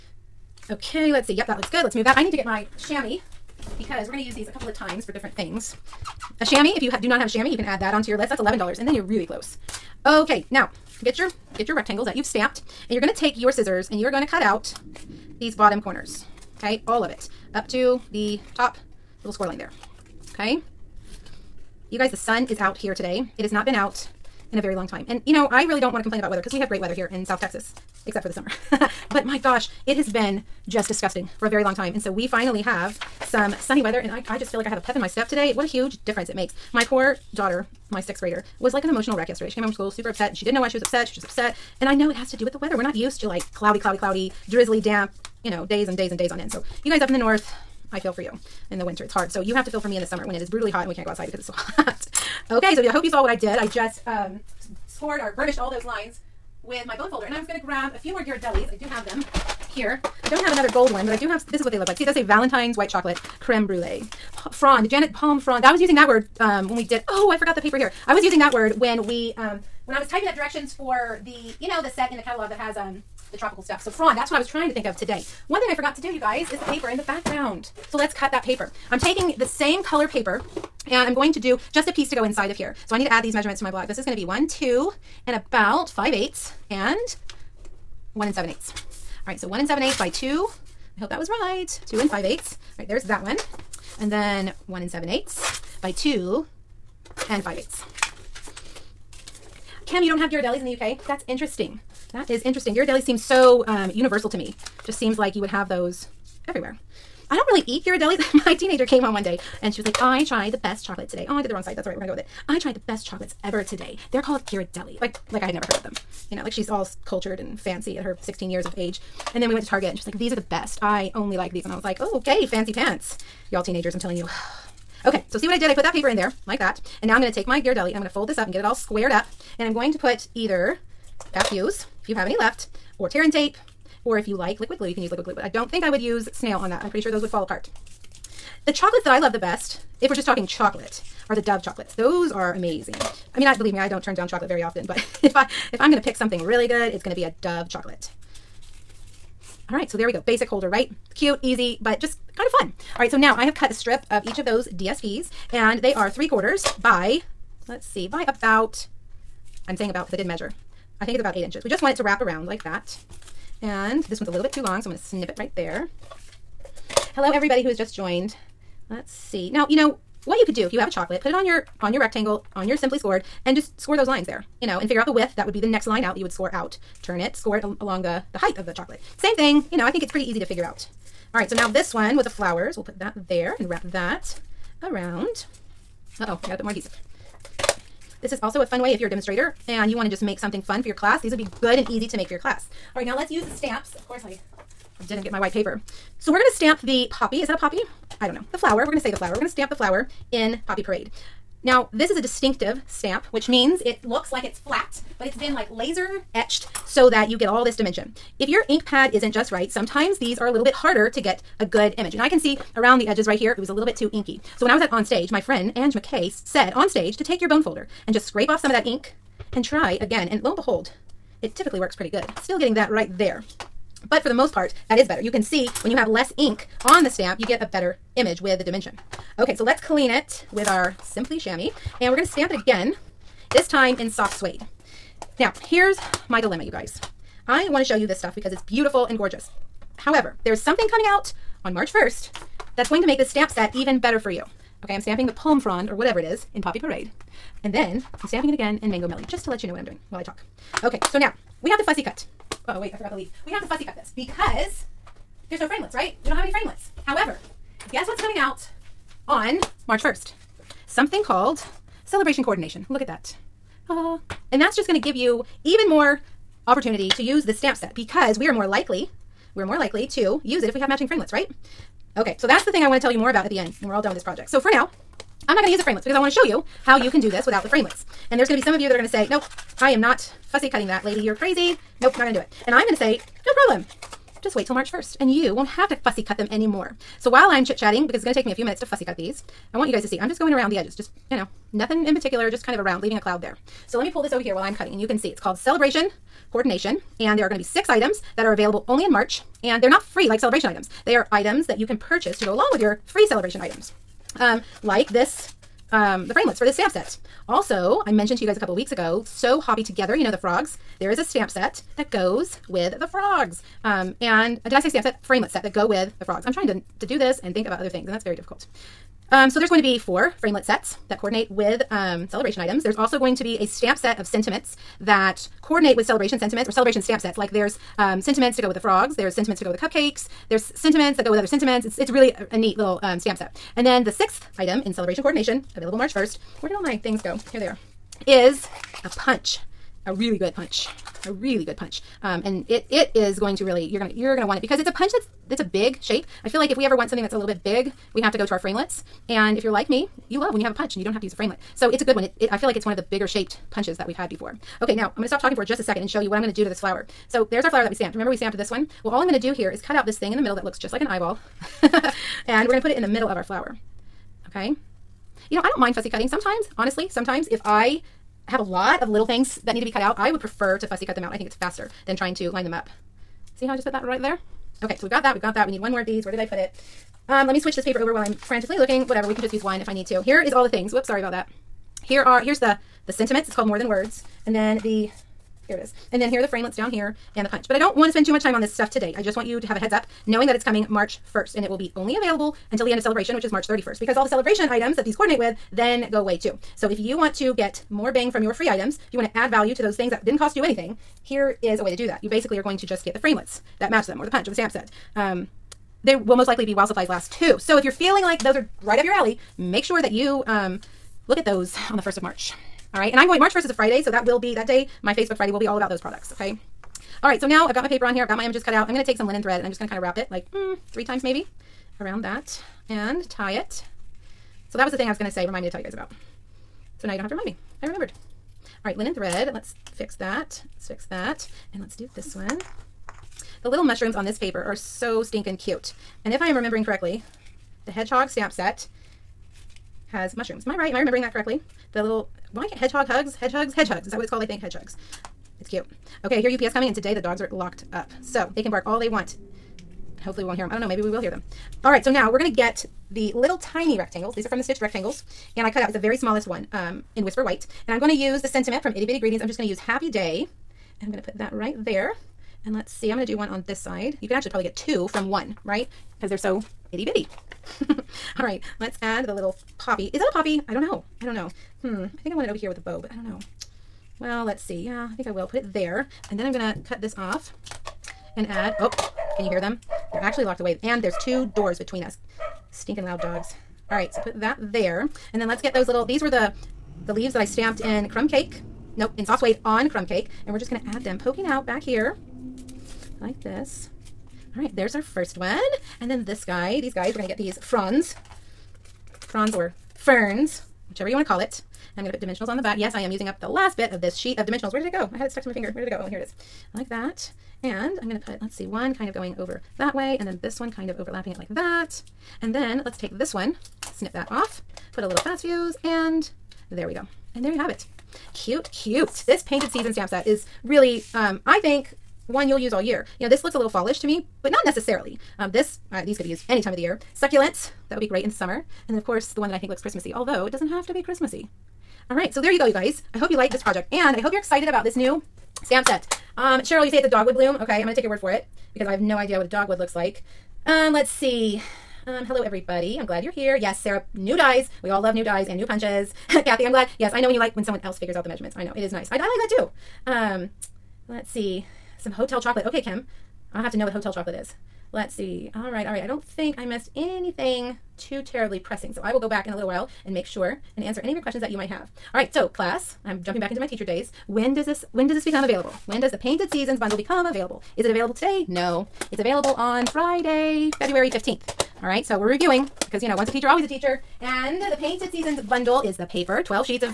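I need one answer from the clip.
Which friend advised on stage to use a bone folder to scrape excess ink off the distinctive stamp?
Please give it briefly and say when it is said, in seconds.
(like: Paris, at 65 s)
Ange McKay, at 215 s.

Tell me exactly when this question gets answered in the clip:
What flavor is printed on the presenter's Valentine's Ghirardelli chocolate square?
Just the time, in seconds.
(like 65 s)
62 s.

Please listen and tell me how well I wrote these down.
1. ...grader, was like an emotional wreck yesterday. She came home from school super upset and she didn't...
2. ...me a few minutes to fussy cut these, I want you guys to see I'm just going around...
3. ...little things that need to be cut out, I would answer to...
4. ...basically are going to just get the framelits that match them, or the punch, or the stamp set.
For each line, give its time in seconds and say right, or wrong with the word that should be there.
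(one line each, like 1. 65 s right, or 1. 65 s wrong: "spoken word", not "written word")
1. 38 s right
2. 288 s right
3. 369 s wrong: "prefer", not "answer"
4. 402 s right.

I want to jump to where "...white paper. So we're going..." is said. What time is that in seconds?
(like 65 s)
195 s.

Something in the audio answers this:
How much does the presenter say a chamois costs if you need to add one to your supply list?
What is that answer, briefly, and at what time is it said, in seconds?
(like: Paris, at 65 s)
$11, at 8 s.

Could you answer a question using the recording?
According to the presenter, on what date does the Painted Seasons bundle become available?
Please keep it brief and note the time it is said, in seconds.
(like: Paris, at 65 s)
February 15th, at 570 s.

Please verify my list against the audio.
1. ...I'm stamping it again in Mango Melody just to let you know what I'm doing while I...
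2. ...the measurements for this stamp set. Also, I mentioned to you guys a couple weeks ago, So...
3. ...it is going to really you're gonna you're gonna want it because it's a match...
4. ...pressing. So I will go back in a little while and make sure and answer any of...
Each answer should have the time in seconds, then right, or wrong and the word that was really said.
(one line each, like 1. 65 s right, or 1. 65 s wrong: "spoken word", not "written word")
1. 248 s right
2. 306 s wrong: "framelits", not "measurements"
3. 342 s wrong: "punch", not "match"
4. 558 s right.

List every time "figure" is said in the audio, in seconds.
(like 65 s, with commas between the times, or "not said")
174 s, 180 s, 547 s.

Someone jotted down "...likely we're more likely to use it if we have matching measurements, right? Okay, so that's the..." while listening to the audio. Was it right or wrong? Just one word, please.
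wrong.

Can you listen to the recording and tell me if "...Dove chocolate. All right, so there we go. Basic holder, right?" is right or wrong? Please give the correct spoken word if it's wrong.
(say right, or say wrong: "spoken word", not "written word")
right.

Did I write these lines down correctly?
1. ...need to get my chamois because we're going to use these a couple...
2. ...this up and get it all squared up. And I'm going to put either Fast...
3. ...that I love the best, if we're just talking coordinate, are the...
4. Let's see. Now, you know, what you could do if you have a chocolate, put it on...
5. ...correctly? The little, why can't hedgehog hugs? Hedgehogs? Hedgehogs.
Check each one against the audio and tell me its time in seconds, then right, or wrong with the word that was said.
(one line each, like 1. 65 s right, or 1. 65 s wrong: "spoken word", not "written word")
1. 2 s right
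2. 128 s right
3. 139 s wrong: "chocolate", not "coordinate"
4. 168 s right
5. 441 s right.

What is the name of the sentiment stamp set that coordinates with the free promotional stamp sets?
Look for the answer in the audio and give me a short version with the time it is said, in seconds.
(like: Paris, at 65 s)
More Than Words, at 383 s.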